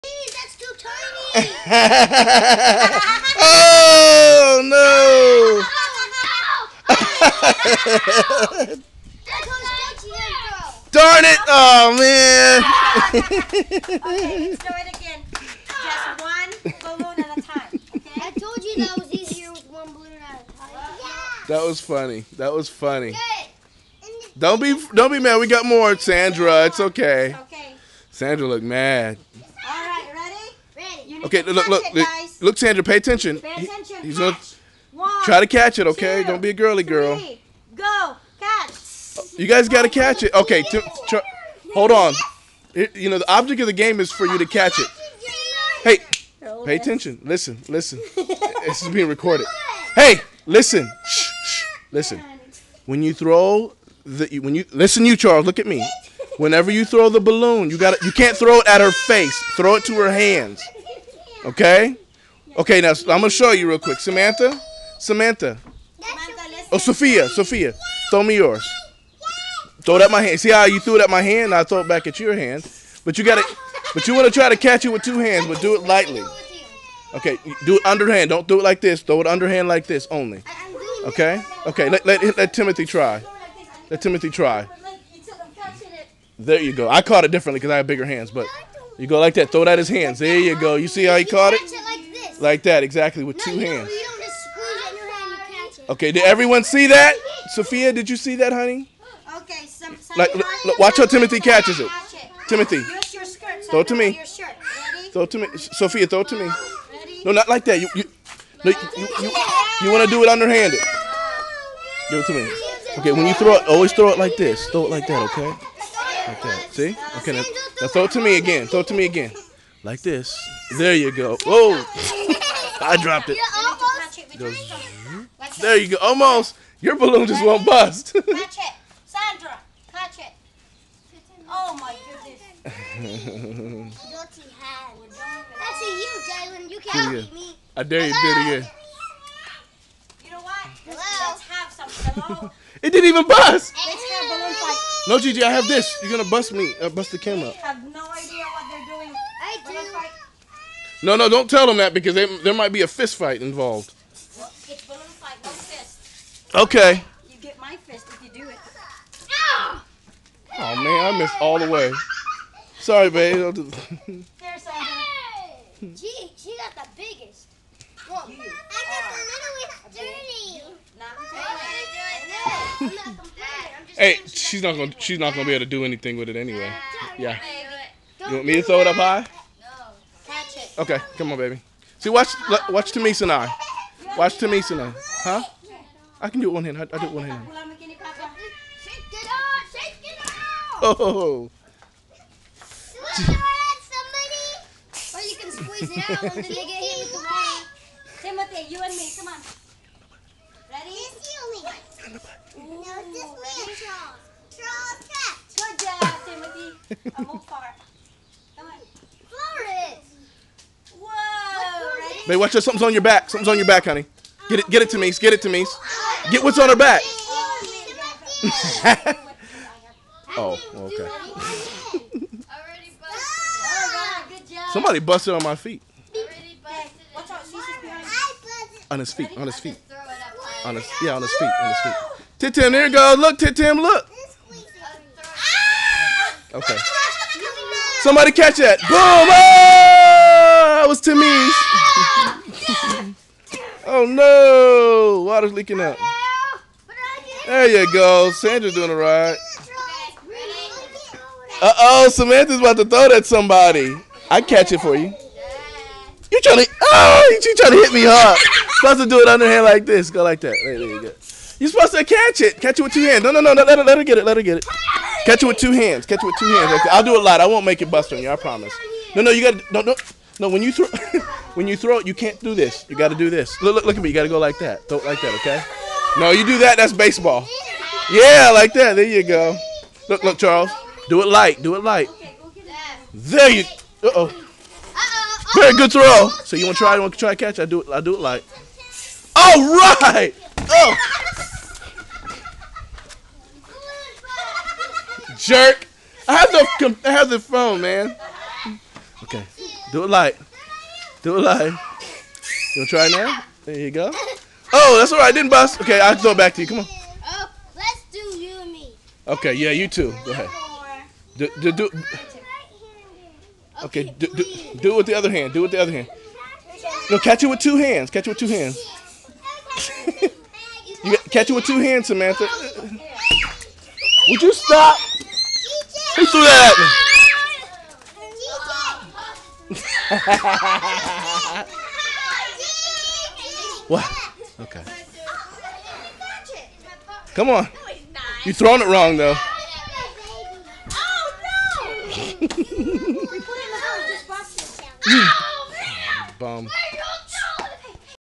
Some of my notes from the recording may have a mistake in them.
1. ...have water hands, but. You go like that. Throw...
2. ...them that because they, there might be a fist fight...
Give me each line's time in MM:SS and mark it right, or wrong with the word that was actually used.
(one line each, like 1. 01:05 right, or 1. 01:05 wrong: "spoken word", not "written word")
1. 01:27 wrong: "bigger", not "water"
2. 02:31 right.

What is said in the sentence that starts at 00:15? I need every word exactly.
Just one balloon at a I told you that was easier with one balloon at a time.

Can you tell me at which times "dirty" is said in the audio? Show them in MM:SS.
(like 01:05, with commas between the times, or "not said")
02:12, 02:50.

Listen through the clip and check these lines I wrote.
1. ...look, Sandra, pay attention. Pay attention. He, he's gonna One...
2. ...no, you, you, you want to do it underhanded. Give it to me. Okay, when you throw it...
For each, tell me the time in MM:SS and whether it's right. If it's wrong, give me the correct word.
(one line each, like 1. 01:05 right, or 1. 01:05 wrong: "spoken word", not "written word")
1. 00:32 right
2. 01:48 right.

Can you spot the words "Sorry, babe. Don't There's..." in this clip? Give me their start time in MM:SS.
02:42.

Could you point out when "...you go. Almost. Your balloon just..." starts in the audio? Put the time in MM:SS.
02:05.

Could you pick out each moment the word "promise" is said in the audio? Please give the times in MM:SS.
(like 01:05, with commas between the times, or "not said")
04:28.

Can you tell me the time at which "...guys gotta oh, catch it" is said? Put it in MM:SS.
00:39.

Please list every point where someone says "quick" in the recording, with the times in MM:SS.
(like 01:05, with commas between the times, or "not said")
01:03.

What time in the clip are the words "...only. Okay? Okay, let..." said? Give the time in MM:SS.
01:20.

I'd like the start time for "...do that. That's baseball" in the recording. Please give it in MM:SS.
04:36.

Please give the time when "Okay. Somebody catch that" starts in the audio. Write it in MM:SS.
03:56.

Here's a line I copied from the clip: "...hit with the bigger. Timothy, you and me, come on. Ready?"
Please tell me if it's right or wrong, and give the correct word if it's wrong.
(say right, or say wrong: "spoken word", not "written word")
wrong: "water", not "bigger".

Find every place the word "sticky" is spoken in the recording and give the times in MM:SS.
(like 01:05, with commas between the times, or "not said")
not said.